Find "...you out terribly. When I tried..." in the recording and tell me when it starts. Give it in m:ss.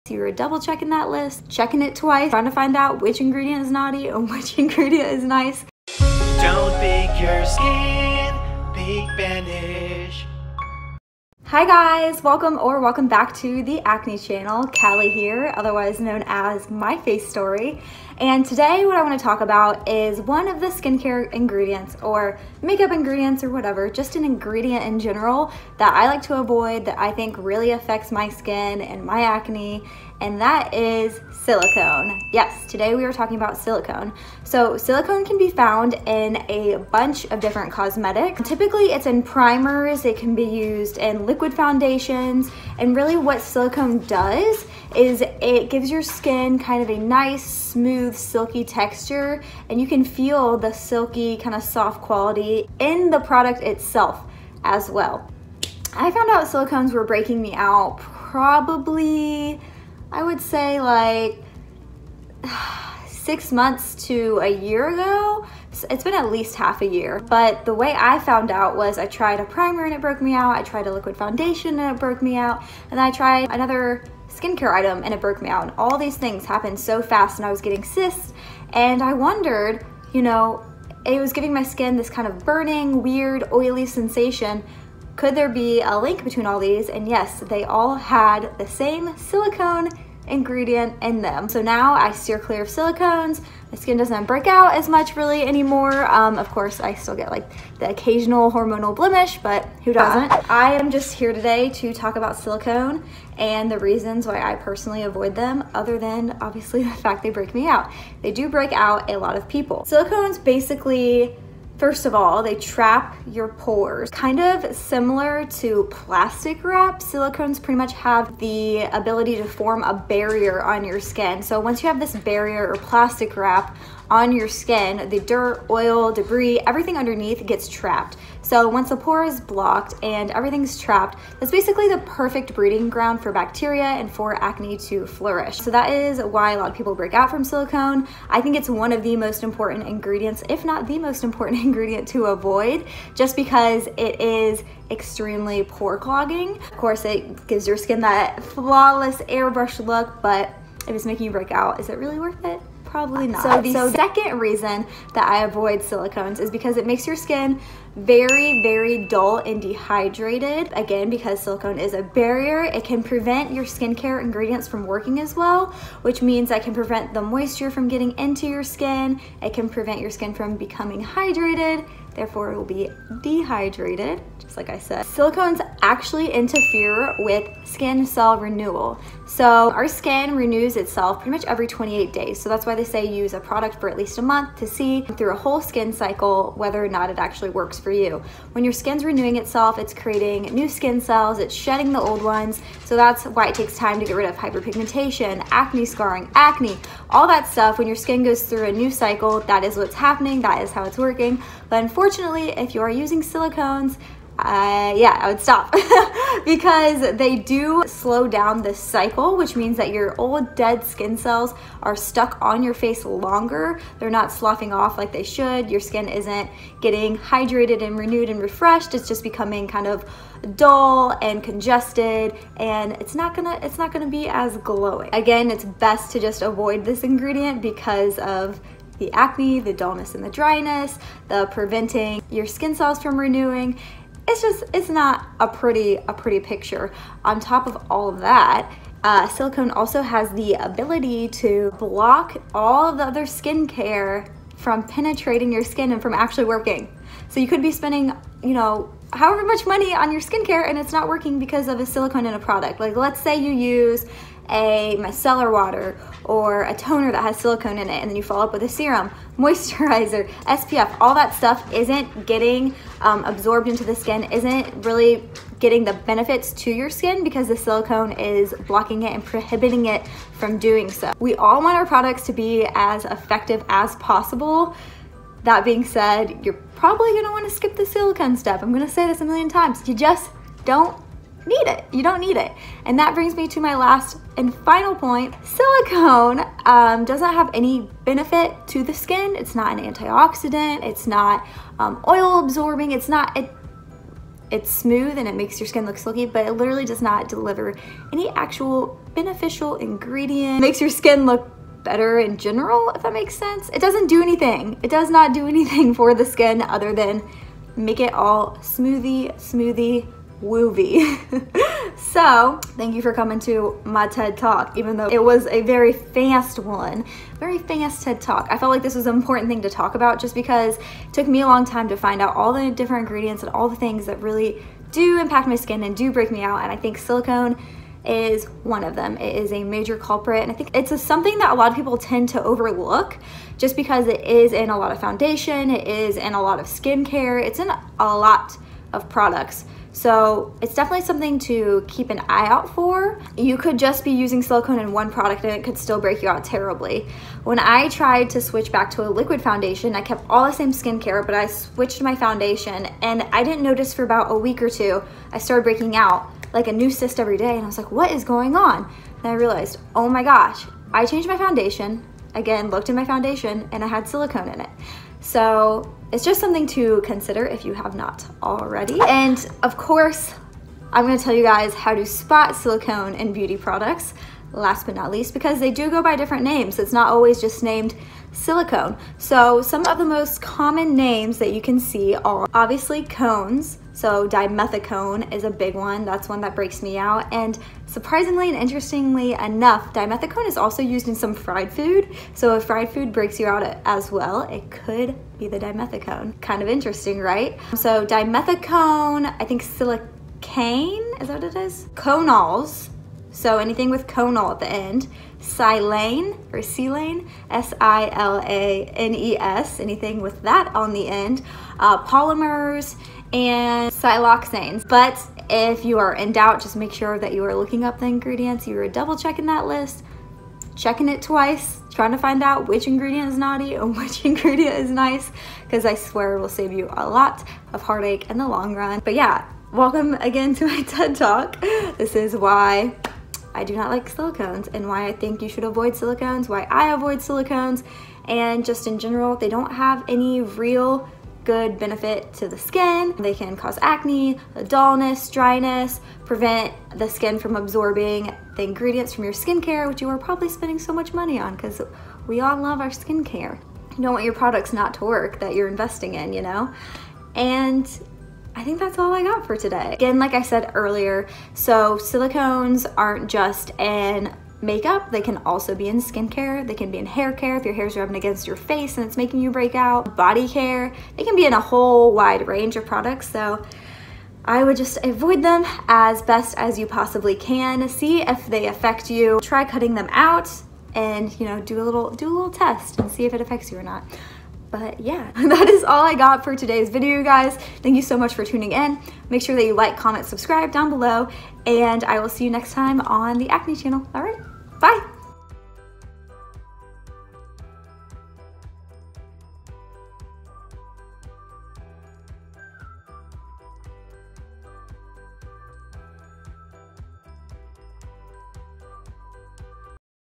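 5:46.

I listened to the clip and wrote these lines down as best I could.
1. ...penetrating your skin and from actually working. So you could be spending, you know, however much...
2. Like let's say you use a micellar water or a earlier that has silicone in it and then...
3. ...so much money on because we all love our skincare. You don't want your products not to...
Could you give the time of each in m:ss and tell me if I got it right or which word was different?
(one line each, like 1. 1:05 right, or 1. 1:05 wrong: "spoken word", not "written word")
1. 4:04 right
2. 4:12 wrong: "toner", not "earlier"
3. 7:30 right.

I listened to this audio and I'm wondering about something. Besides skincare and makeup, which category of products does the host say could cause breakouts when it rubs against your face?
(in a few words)
hair care.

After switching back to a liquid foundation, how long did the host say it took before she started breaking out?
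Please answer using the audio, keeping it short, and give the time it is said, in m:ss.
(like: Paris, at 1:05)
a week or two, at 5:54.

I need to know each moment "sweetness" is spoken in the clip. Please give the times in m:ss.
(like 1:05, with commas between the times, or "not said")
not said.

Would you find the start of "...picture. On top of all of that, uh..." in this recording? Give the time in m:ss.
3:56.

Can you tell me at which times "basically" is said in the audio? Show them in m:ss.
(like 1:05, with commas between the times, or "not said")
1:50, 2:11.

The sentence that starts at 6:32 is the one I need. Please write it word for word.
So if fried food breaks you out as well, it could be the dimethicone.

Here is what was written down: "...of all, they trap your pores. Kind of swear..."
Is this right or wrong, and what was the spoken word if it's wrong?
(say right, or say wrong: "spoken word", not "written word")
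wrong: "similar", not "swear".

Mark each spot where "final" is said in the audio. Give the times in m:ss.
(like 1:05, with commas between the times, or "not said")
4:44.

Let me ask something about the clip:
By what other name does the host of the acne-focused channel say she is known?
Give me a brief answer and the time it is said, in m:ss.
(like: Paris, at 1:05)
My Face Story, at 0:16.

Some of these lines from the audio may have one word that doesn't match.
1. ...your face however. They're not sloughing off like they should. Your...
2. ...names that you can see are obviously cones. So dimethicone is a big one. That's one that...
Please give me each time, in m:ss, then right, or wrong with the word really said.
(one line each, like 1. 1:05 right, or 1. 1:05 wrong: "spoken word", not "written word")
1. 3:32 wrong: "longer", not "however"
2. 6:20 right.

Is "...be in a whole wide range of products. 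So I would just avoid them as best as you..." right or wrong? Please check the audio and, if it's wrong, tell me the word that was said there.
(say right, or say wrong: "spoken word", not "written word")
right.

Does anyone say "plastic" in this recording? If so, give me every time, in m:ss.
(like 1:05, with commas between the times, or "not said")
1:55, 2:02.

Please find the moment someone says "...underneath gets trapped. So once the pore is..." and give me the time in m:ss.
2:06.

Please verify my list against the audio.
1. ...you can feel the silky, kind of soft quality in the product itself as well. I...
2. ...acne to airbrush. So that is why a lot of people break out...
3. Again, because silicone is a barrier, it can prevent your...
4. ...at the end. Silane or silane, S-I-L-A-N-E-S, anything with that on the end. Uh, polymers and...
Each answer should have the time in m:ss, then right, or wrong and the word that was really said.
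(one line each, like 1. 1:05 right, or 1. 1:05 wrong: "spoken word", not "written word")
1. 0:49 right
2. 2:14 wrong: "flourish", not "airbrush"
3. 2:40 right
4. 6:44 right.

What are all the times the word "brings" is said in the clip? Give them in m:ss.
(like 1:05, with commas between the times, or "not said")
4:43.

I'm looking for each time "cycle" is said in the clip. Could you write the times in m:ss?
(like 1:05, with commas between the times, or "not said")
3:05, 3:18, 3:28.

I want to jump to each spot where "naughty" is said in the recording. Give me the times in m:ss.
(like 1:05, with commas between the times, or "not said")
0:03, 7:03.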